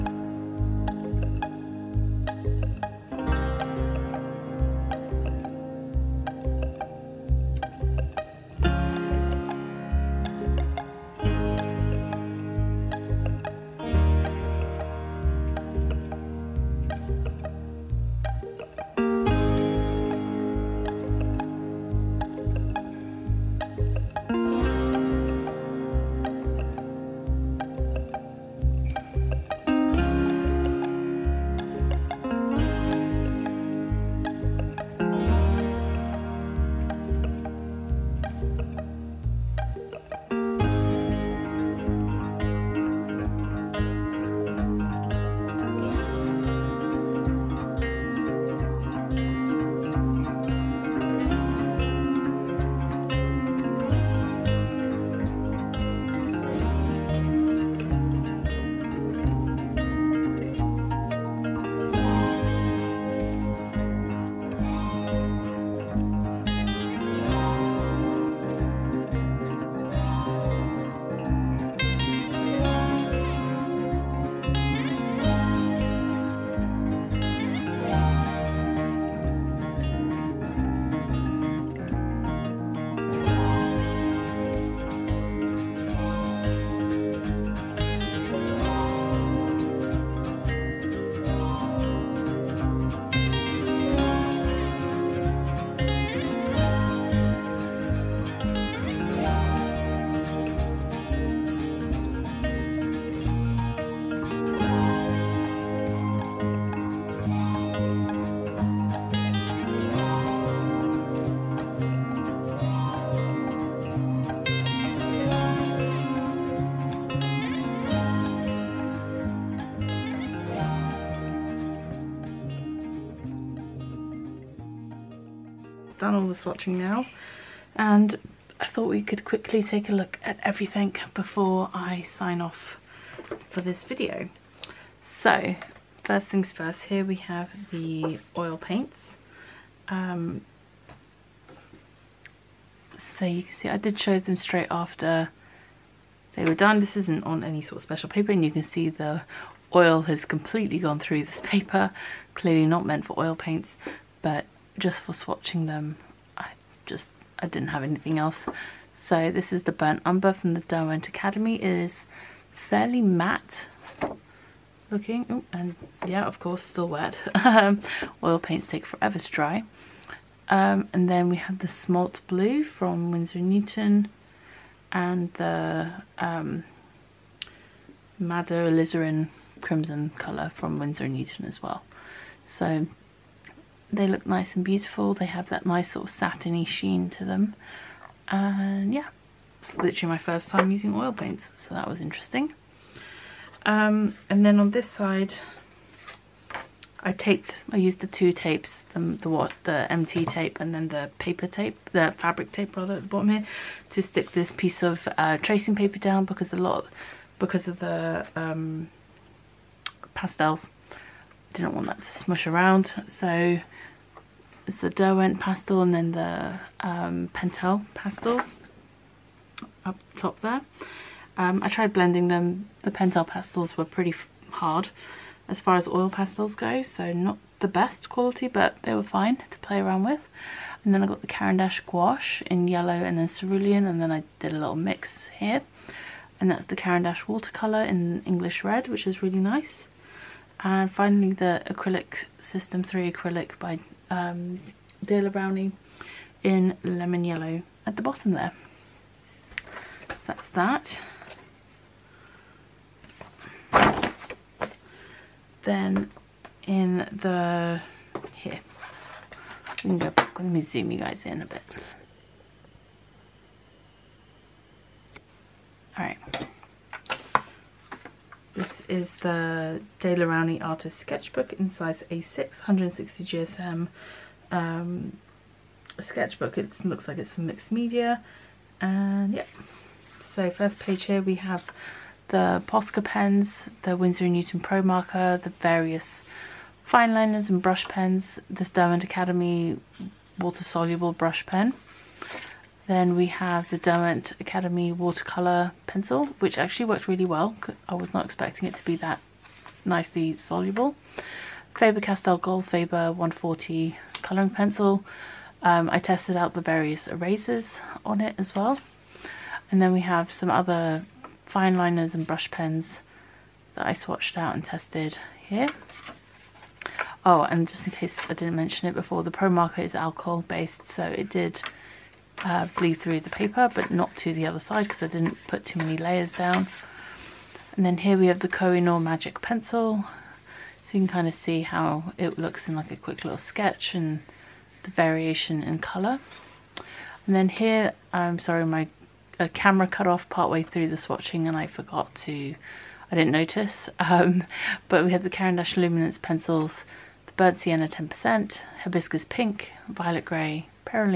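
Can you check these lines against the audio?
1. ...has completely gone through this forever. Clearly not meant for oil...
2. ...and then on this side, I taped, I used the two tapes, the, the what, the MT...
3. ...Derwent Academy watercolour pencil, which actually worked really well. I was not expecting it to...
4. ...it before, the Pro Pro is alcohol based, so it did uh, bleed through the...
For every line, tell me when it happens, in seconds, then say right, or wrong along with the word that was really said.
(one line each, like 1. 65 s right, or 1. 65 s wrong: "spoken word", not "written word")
1. 150 s wrong: "paper", not "forever"
2. 194 s right
3. 293 s right
4. 318 s wrong: "Marker", not "Pro".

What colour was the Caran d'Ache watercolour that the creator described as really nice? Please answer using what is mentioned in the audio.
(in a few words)
English red.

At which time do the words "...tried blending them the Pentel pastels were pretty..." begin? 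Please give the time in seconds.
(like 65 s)
221 s.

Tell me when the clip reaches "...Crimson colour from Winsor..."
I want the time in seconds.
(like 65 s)
179 s.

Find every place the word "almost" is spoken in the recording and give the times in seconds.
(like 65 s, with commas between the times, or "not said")
not said.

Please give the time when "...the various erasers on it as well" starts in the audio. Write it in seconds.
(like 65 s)
306 s.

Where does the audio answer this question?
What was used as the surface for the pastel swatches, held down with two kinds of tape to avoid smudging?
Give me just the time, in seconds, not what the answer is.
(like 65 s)
205 s.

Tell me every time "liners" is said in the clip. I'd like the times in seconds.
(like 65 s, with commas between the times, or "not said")
287 s, 311 s.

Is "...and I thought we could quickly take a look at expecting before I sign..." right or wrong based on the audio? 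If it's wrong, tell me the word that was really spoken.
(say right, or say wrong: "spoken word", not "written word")
wrong: "everything", not "expecting".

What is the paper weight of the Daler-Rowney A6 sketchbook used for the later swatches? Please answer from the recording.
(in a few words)
160 GSM.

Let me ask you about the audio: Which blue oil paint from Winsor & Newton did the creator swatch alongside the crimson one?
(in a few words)
Smalt Blue.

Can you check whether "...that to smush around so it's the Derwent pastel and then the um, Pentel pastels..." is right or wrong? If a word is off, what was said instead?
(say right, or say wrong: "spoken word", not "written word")
right.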